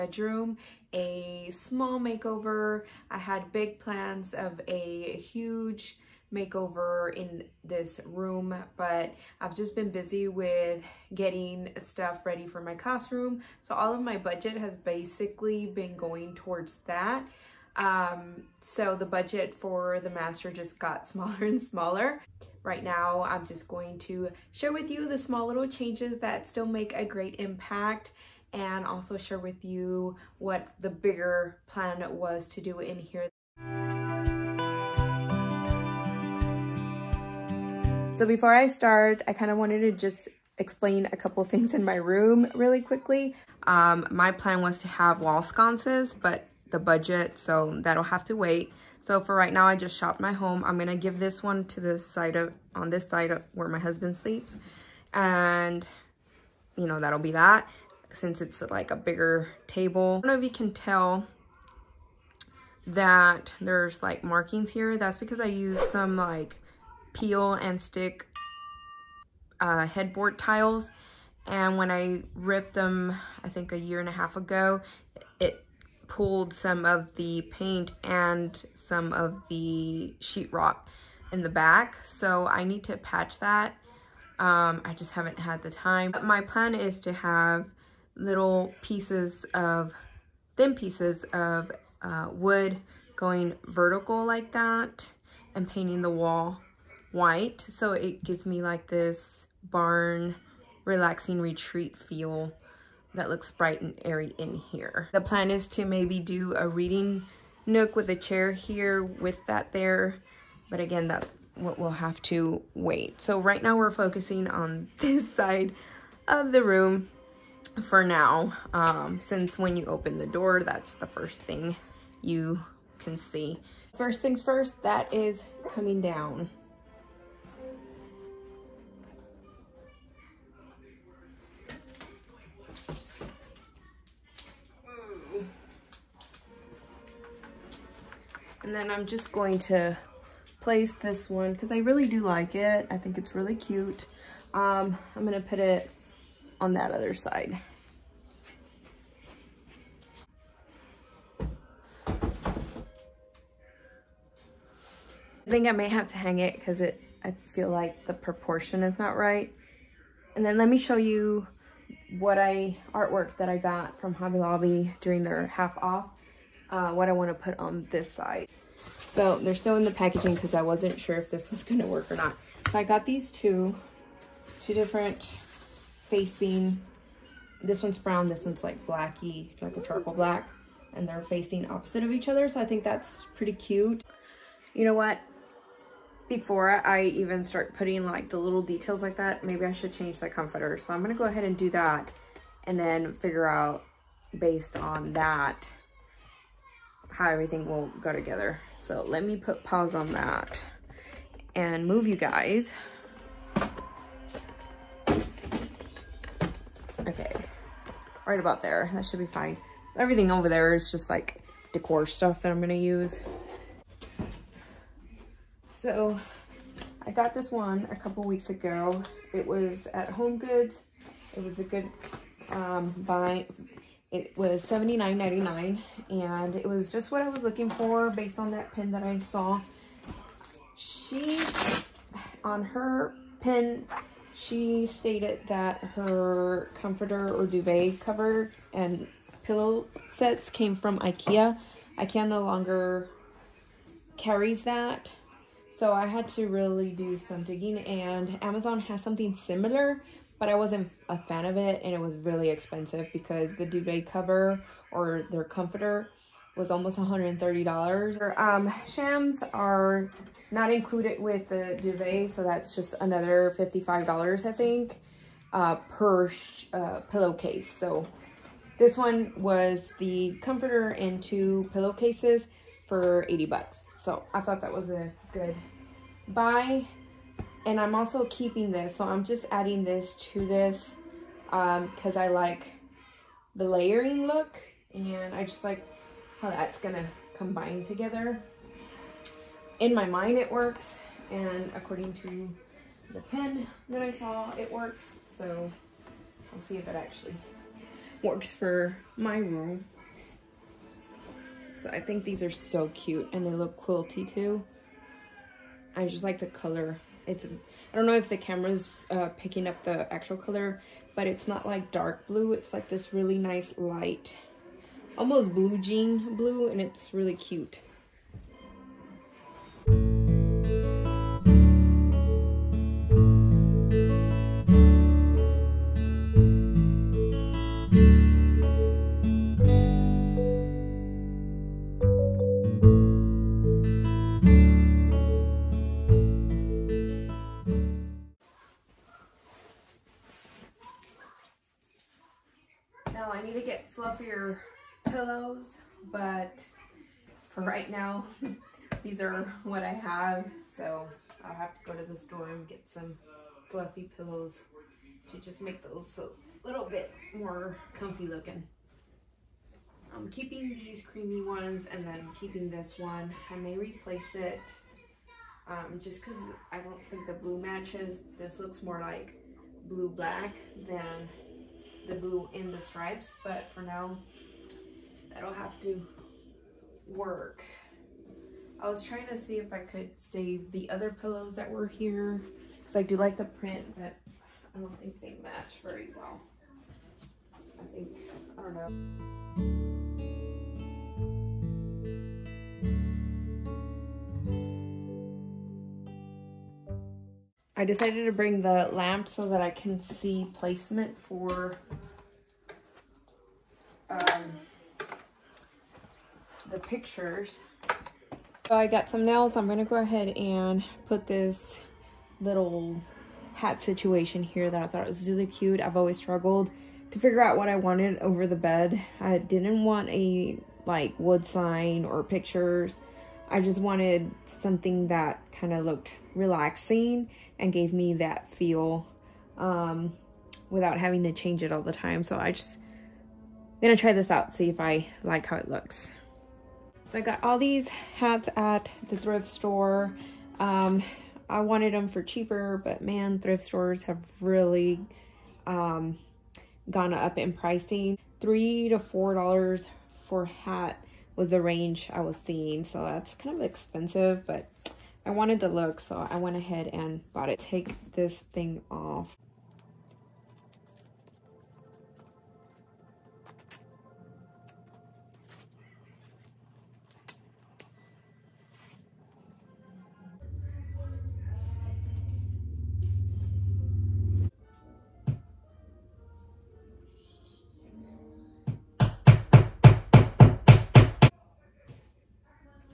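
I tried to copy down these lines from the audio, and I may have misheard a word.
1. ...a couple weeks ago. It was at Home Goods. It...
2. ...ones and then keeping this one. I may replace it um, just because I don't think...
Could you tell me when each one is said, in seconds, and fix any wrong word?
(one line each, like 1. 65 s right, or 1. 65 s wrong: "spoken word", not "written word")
1. 217 s right
2. 361 s right.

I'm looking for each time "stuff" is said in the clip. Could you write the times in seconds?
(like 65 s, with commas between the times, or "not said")
11 s, 212 s.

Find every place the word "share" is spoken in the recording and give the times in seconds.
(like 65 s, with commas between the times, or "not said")
24 s, 29 s.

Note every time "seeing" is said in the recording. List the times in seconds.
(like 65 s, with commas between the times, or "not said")
452 s.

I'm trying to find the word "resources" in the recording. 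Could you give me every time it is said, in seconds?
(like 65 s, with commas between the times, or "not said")
not said.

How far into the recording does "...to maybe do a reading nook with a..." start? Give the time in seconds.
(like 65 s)
105 s.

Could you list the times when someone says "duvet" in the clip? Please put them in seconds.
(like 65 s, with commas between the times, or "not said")
237 s, 253 s, 261 s.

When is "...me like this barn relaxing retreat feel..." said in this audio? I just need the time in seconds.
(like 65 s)
98 s.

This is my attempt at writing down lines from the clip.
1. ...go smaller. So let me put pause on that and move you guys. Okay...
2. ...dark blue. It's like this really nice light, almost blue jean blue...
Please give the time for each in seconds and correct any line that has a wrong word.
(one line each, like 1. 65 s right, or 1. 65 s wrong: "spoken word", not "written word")
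1. 198 s wrong: "together", not "smaller"
2. 311 s right.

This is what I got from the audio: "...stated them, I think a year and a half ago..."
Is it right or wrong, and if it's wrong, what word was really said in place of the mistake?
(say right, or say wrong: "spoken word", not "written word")
wrong: "ripped", not "stated".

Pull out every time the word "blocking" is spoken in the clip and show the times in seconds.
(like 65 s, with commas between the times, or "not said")
not said.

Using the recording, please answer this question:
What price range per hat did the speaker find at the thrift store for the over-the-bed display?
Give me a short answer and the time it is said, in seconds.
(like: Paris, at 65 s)
3 to 4 dollars, at 448 s.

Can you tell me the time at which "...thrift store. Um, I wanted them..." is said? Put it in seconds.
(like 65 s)
439 s.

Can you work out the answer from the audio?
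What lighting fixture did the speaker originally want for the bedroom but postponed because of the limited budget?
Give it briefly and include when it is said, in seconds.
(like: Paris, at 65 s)
wall sconces, at 45 s.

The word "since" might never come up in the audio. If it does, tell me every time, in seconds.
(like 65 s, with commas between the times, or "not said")
58 s, 119 s.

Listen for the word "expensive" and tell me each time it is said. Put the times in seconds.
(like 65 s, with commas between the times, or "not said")
252 s, 453 s.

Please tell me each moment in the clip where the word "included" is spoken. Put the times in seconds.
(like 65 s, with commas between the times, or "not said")
260 s.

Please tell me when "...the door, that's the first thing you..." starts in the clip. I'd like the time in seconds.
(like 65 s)
120 s.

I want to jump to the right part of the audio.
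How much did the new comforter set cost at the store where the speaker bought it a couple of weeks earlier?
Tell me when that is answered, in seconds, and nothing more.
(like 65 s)
224 s.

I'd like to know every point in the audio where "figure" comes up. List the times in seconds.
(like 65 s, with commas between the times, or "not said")
193 s, 417 s.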